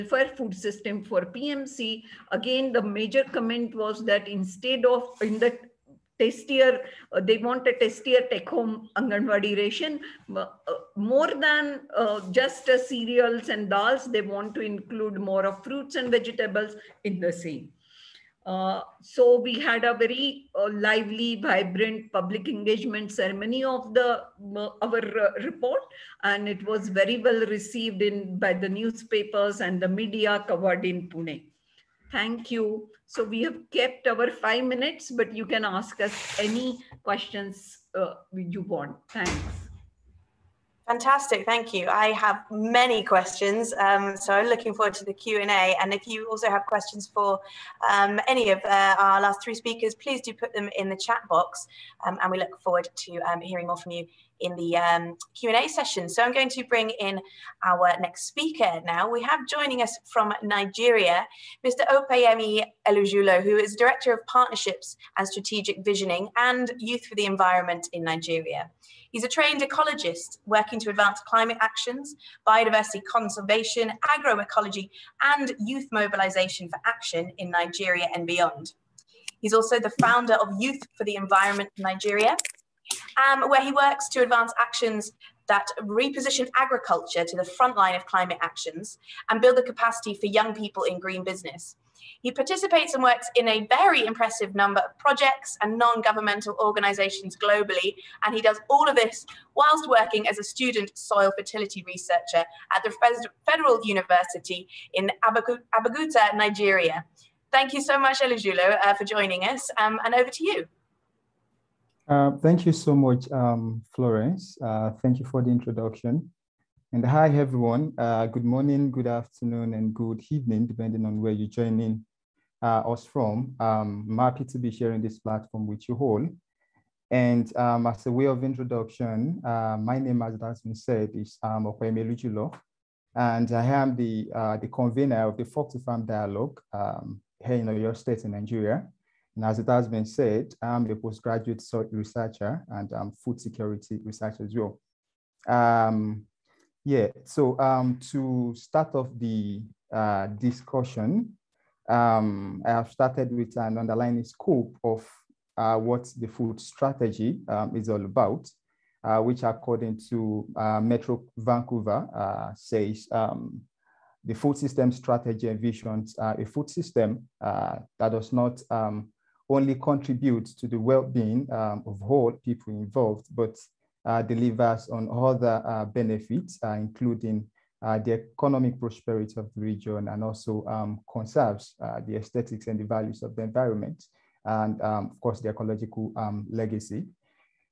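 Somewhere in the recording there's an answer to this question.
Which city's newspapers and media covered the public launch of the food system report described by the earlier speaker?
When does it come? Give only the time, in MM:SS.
00:31.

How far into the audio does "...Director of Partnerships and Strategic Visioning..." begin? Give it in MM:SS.
01:03.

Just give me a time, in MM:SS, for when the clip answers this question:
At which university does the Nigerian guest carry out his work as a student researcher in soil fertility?
01:43.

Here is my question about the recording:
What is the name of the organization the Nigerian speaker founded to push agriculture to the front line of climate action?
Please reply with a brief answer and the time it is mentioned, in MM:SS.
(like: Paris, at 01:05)
Youth for the Environment Nigeria, at 01:20.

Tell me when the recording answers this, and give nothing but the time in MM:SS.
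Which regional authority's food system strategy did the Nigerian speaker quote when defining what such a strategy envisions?
02:40.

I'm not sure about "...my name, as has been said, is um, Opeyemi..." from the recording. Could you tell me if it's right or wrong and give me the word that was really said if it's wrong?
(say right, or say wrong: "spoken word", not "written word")
right.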